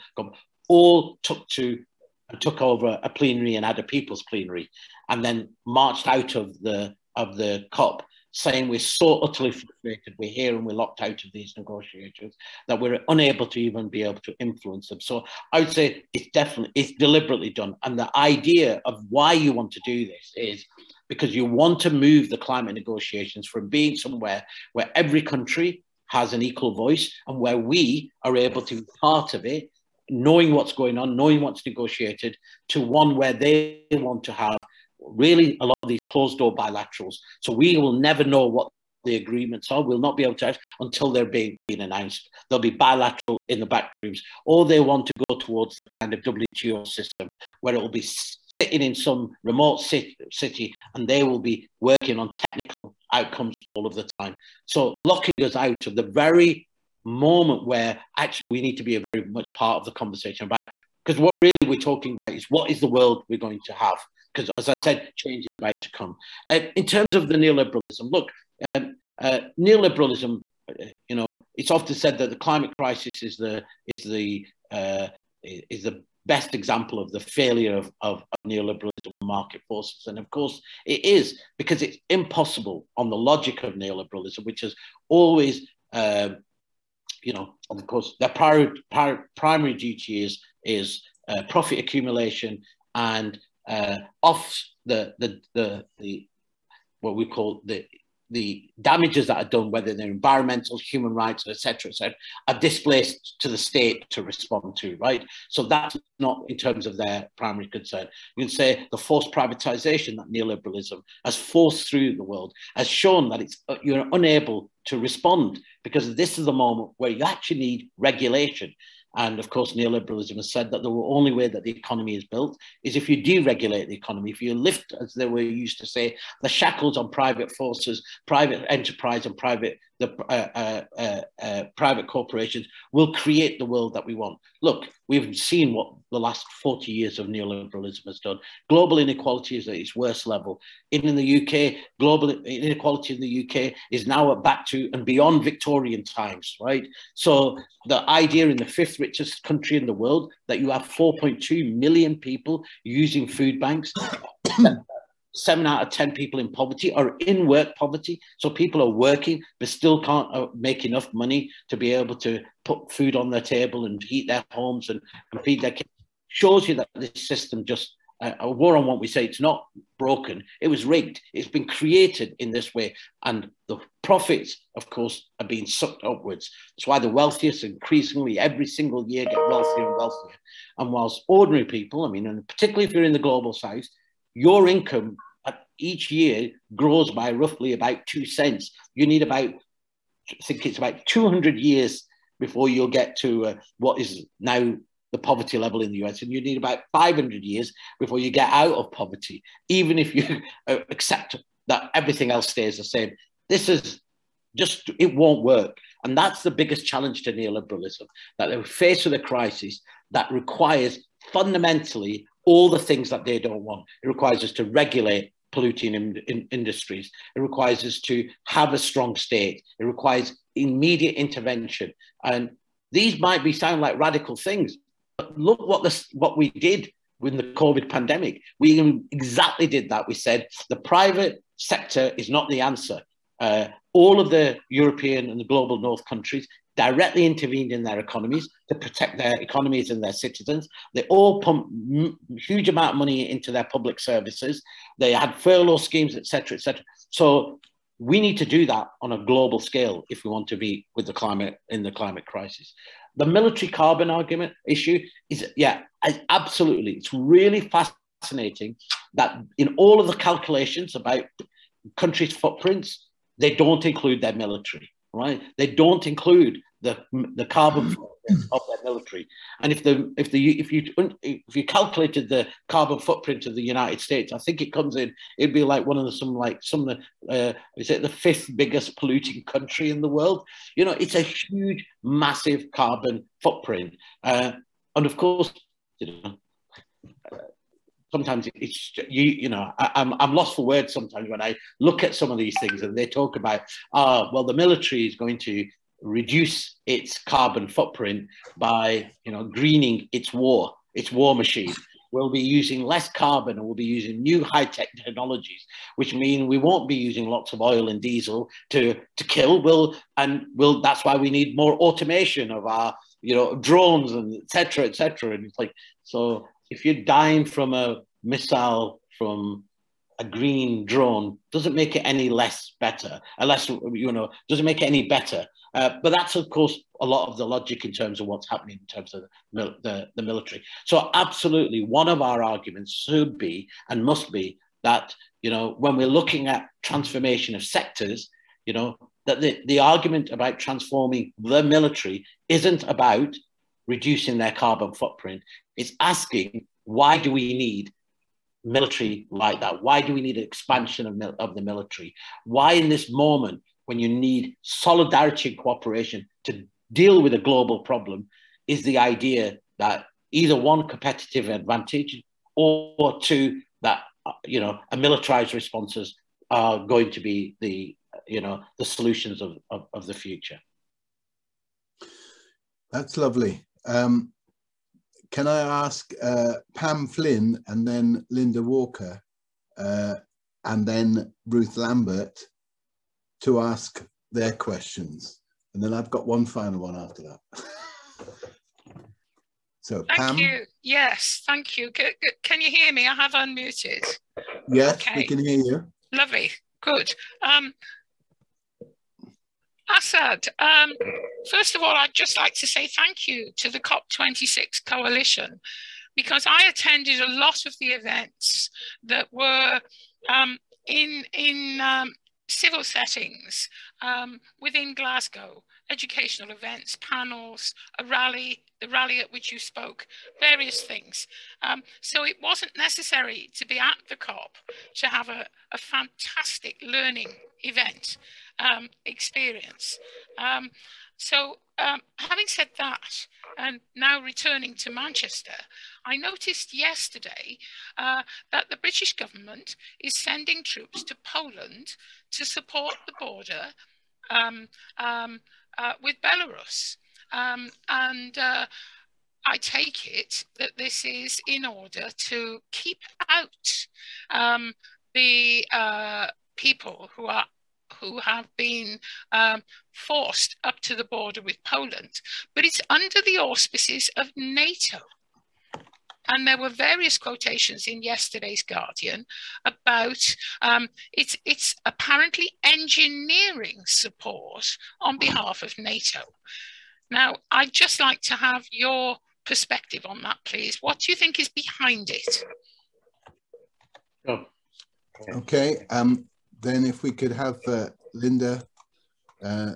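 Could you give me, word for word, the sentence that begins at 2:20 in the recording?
Even in the UK, global inequality in the UK is now back to and beyond Victorian times, right?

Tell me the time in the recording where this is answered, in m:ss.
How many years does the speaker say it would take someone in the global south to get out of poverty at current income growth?
3:16.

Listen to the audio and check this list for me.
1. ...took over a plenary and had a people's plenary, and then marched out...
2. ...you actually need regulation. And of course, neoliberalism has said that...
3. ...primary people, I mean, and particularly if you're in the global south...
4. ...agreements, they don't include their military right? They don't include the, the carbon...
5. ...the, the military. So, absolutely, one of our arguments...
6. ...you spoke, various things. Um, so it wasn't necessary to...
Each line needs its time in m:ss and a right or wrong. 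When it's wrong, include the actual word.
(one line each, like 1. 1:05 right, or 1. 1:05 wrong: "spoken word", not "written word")
1. 0:02 right
2. 1:57 right
3. 3:01 wrong: "ordinary", not "primary"
4. 4:22 wrong: "footprints", not "agreements"
5. 5:29 right
6. 6:59 right.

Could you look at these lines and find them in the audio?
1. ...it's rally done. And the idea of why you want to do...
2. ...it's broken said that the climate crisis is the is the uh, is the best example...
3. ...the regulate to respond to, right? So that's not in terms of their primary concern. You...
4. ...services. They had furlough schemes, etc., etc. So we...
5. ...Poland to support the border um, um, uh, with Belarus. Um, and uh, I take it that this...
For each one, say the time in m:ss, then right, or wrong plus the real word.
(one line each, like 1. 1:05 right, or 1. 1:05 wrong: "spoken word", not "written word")
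1. 0:16 wrong: "deliberately", not "rally"
2. 1:11 wrong: "often", not "broken"
3. 1:43 wrong: "state", not "regulate"
4. 4:03 right
5. 7:21 right.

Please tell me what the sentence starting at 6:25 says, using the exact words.
And then I've got one final one after that.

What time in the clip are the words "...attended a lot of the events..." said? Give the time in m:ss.
6:46.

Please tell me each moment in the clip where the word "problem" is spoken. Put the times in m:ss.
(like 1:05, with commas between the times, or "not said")
5:57.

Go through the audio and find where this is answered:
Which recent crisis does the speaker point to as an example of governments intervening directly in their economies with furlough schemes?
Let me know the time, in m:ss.
3:47.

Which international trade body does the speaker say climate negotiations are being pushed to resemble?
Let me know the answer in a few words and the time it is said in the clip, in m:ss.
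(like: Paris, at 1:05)
WTO, at 0:46.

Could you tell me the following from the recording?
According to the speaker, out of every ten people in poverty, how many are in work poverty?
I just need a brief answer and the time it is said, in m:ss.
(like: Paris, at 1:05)
7, at 2:35.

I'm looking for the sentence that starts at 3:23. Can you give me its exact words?
This is just, it won't work.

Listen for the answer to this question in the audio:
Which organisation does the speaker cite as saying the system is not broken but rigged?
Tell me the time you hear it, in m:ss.
2:48.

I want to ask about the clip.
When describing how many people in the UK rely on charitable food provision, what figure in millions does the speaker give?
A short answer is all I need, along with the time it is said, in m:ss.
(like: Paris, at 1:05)
4.2 million, at 2:30.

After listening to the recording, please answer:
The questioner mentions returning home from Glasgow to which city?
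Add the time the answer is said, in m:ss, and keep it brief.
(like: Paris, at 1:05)
Manchester, at 7:14.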